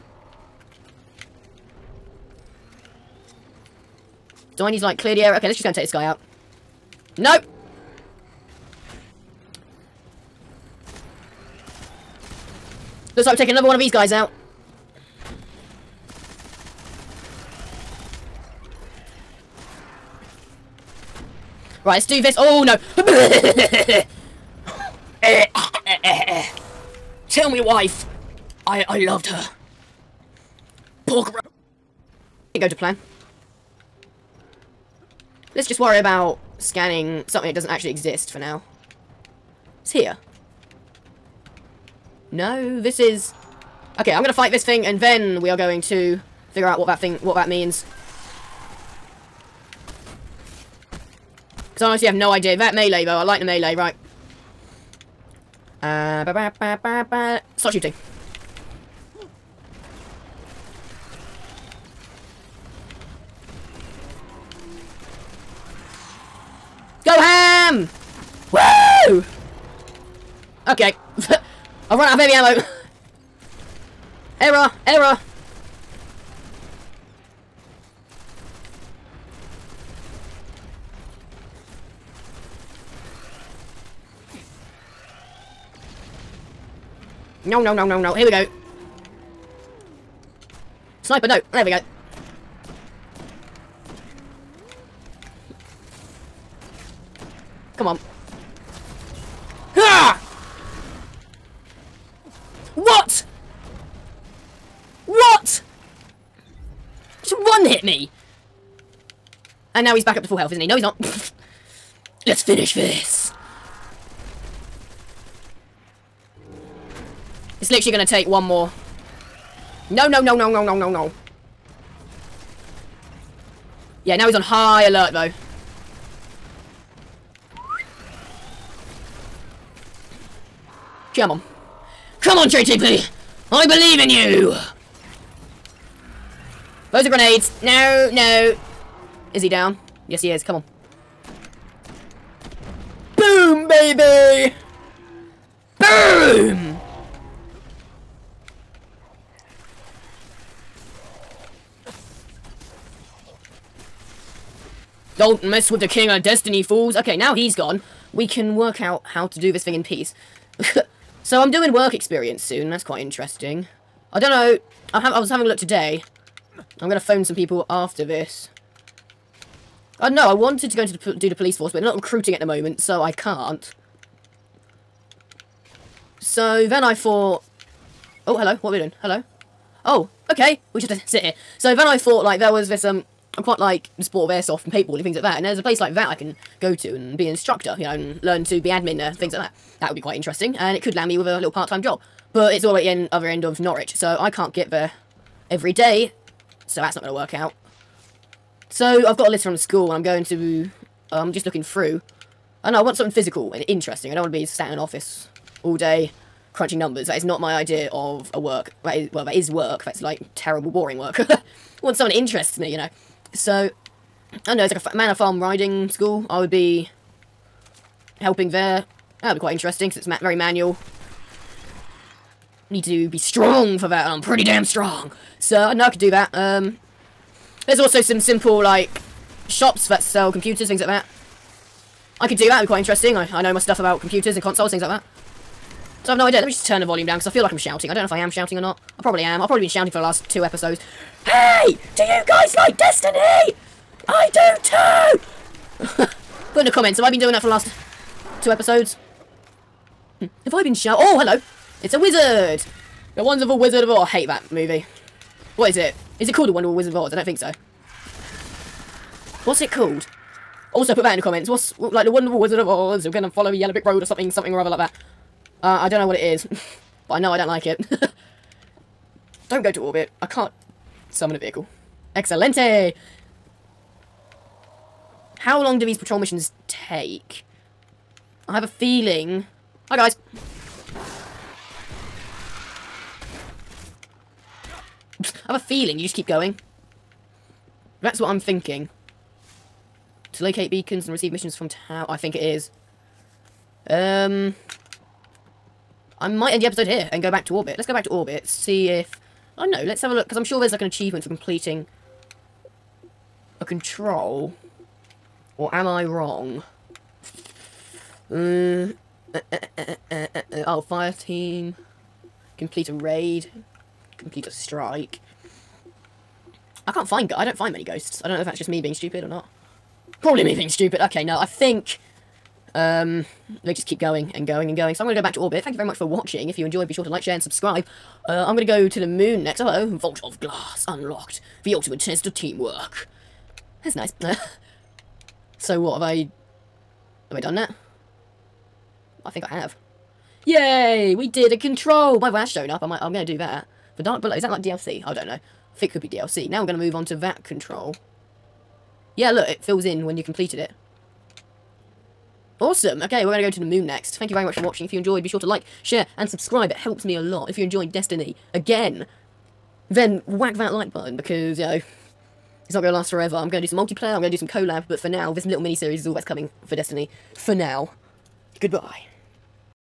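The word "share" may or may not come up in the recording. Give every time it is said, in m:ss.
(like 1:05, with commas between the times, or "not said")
5:27, 5:55.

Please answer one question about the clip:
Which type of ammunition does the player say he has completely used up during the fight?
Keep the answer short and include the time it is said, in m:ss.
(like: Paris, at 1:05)
Heavy ammo, at 1:12.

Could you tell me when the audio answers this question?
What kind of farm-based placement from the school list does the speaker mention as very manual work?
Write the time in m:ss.
3:34.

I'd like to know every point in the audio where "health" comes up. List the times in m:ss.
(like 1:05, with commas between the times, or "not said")
1:50.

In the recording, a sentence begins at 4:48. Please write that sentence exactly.
That's what I'm thinking to locate beacons and receive missions from town.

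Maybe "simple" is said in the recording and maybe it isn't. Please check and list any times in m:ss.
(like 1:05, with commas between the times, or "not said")
3:48.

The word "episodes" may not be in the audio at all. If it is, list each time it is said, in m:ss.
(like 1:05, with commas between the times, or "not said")
4:00, 4:08, 4:56.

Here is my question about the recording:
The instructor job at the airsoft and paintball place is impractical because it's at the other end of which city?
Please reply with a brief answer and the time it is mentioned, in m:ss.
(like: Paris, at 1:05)
Norwich, at 3:13.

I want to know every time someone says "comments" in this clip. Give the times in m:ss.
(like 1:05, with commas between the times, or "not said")
4:06, 4:21.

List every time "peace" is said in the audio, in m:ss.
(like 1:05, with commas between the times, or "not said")
2:39.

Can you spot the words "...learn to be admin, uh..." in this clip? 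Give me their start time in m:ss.
3:08.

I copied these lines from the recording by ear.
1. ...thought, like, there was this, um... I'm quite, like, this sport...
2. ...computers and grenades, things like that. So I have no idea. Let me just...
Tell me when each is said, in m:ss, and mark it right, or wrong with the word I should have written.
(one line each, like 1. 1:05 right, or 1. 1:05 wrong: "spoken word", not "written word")
1. 3:01 right
2. 3:53 wrong: "consoles", not "grenades".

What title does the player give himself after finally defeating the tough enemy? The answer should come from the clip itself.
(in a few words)
King of Destiny.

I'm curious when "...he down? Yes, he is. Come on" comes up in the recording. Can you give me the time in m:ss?
2:19.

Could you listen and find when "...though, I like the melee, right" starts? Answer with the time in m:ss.
0:53.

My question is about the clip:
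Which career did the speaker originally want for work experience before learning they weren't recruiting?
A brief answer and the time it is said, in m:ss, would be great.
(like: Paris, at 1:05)
Police force, at 2:51.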